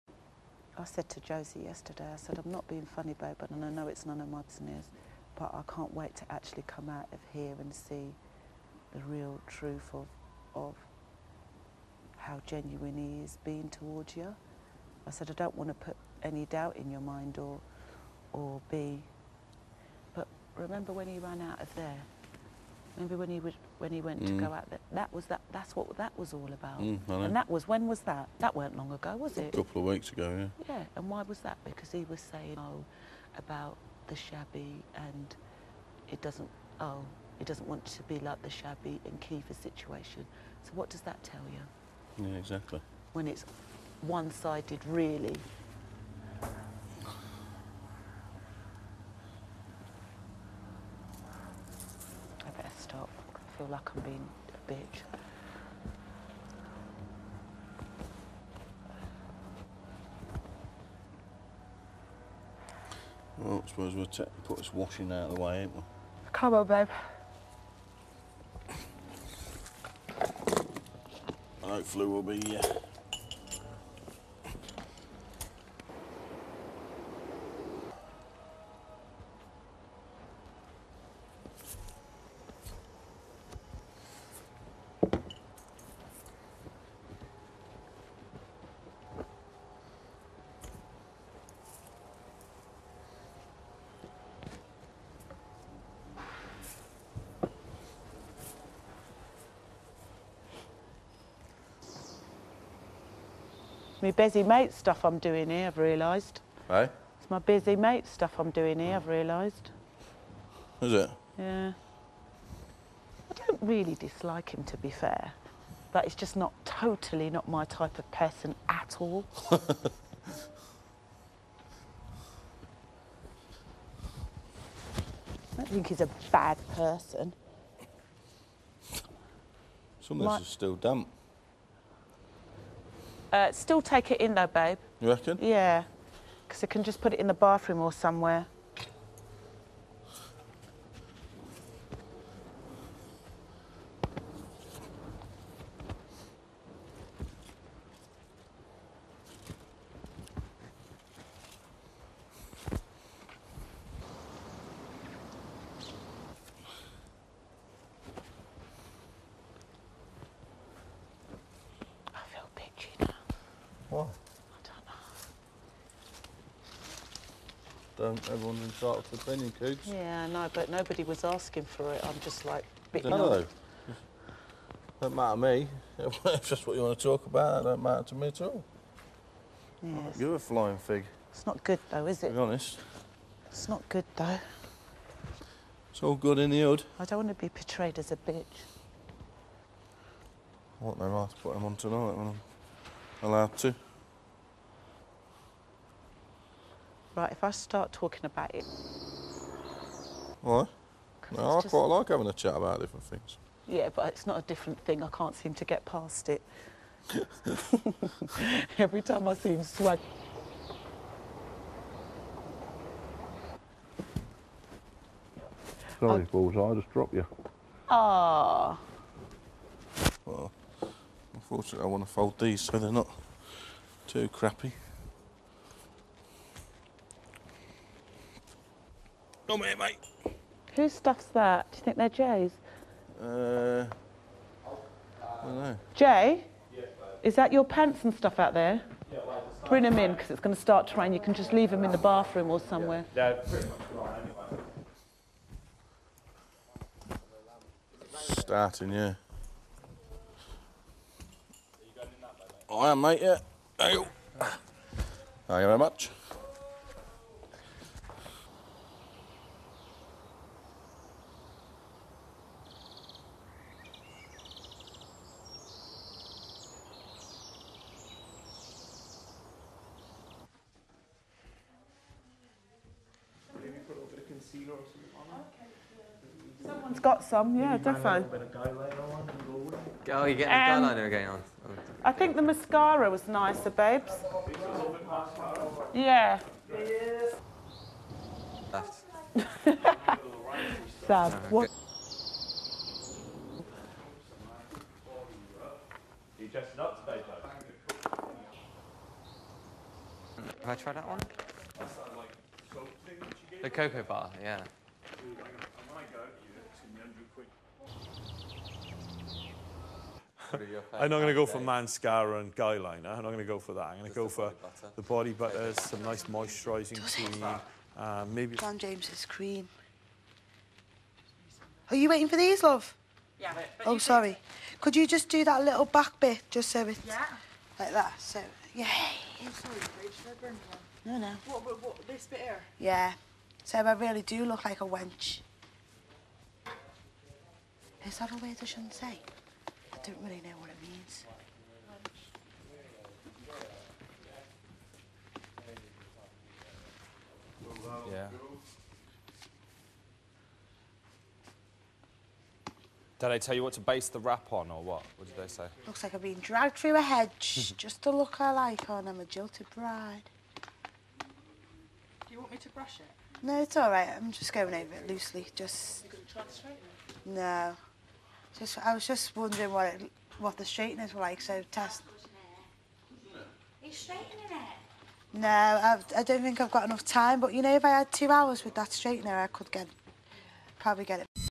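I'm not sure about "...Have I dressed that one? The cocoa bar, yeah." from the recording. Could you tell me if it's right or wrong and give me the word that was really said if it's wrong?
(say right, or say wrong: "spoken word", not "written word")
wrong: "tried", not "dressed".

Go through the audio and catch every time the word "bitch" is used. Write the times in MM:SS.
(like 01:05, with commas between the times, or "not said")
00:54, 03:08.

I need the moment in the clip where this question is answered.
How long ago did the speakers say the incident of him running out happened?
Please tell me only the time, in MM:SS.
00:29.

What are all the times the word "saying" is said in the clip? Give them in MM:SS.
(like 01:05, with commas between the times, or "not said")
00:32.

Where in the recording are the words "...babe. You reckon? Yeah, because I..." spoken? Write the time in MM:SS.
02:14.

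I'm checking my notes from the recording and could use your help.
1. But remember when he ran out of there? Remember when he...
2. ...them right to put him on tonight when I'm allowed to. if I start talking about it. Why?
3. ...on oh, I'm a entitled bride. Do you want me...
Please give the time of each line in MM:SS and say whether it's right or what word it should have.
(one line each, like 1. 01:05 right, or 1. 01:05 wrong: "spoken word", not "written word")
1. 00:20 right
2. 03:10 right
3. 05:58 wrong: "jilted", not "entitled".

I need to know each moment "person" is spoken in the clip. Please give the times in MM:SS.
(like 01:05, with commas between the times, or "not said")
01:58, 02:06.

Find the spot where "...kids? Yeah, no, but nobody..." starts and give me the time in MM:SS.
02:49.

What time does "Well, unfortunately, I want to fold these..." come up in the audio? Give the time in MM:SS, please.
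03:40.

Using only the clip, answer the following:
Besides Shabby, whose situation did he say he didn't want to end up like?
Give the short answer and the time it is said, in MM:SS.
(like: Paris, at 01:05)
Caoimhe, at 00:39.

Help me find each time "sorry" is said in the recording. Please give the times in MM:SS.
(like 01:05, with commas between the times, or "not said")
03:35, 05:23, 05:29.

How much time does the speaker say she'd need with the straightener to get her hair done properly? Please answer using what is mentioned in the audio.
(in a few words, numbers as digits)
2 hours.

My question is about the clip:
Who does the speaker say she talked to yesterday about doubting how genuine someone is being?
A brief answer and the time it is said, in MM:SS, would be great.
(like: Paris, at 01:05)
Josie, at 00:01.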